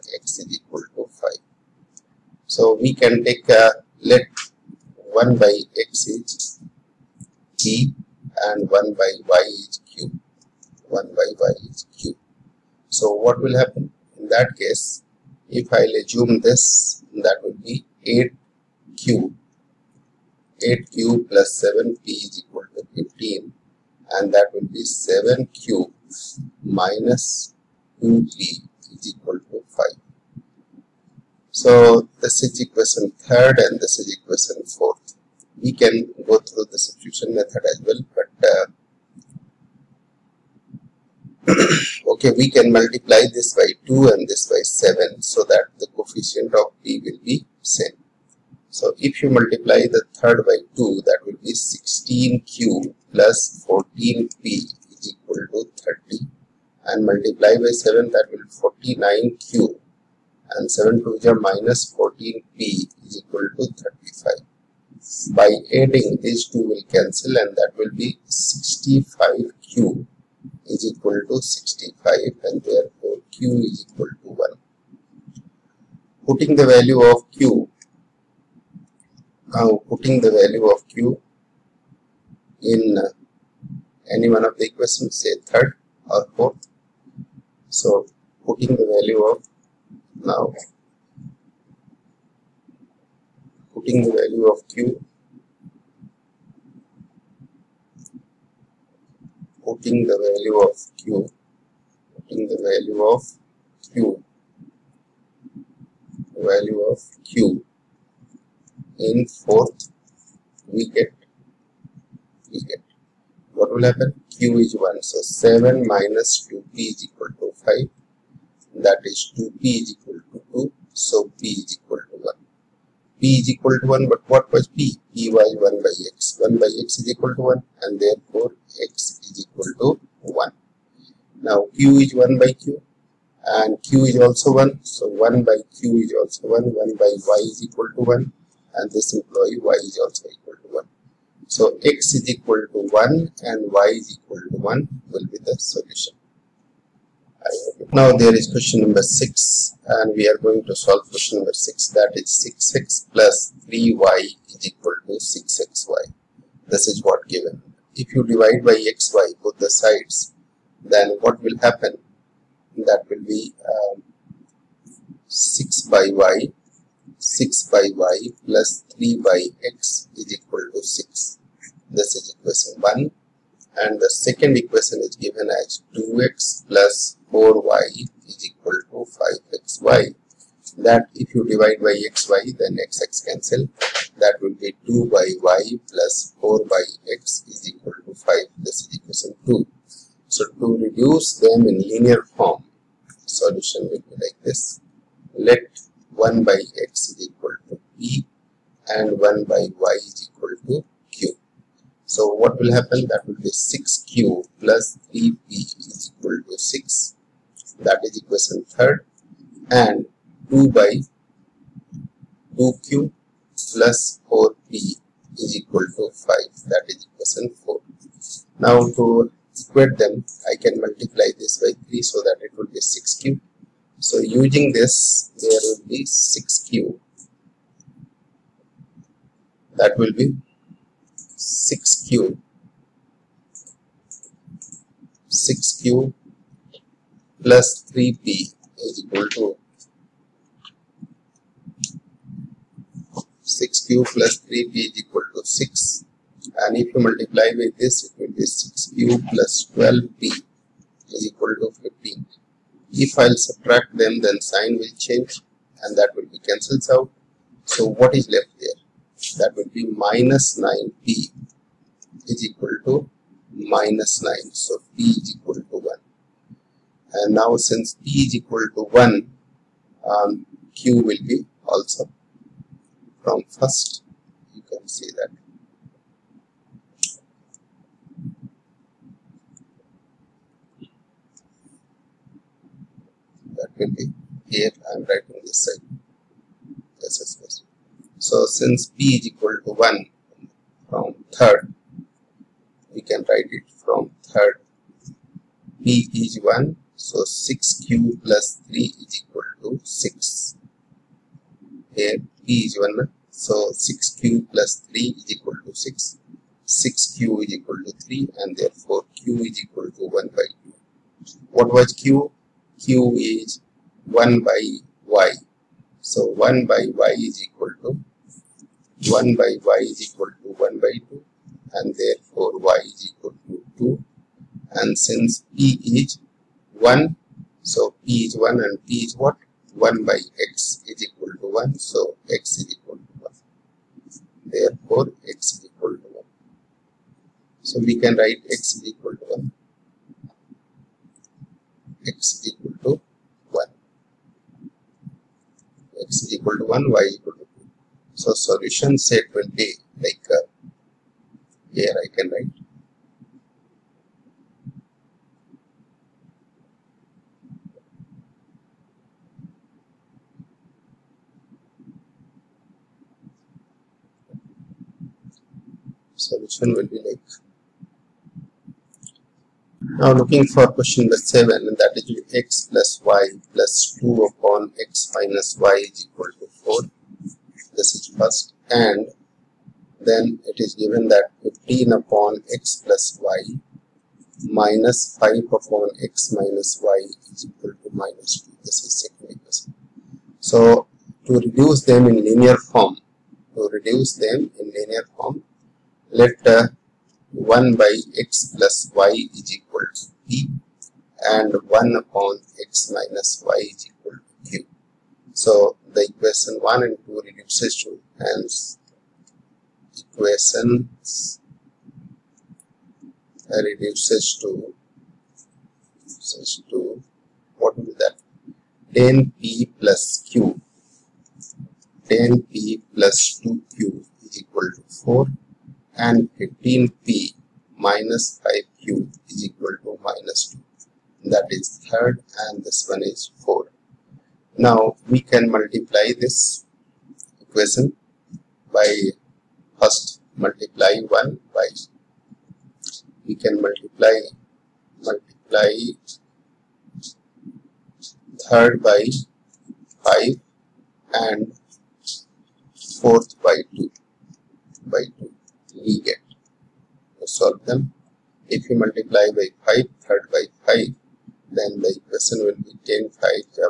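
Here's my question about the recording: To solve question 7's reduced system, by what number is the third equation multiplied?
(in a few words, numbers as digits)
5.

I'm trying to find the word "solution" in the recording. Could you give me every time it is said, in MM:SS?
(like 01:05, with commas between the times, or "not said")
02:25, 03:13, 05:48, 06:06.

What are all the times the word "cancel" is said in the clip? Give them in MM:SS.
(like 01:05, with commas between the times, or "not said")
01:06, 03:03, 04:16.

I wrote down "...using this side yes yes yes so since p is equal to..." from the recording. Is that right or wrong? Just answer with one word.
wrong.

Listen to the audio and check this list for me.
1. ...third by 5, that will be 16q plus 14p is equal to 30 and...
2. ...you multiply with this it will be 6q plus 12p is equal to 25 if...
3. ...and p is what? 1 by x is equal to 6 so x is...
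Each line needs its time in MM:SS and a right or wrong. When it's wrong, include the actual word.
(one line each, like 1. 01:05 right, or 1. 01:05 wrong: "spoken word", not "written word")
1. 00:50 wrong: "2", not "5"
2. 04:06 wrong: "15", not "25"
3. 05:28 wrong: "1", not "6".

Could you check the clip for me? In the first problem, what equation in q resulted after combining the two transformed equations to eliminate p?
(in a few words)
65q = 65.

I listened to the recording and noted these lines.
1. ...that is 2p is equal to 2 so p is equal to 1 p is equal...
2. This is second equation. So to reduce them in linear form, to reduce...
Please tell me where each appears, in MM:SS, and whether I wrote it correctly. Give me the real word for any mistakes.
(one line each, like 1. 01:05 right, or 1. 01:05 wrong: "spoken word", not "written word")
1. 01:58 right
2. 06:28 right.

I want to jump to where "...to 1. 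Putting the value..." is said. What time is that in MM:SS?
01:14.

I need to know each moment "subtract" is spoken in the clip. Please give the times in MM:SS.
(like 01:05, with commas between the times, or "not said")
04:13.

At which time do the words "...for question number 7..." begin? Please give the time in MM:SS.
06:10.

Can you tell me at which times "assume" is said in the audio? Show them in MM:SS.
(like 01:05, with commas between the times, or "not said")
00:16.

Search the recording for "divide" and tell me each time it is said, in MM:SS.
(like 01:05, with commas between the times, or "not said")
02:38, 03:01.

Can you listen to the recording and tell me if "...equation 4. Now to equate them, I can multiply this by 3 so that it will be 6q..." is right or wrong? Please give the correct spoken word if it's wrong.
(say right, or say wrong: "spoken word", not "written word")
right.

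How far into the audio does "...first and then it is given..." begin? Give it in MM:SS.
06:18.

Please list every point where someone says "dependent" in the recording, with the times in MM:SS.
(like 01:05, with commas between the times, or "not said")
not said.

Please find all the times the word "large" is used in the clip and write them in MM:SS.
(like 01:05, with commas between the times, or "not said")
not said.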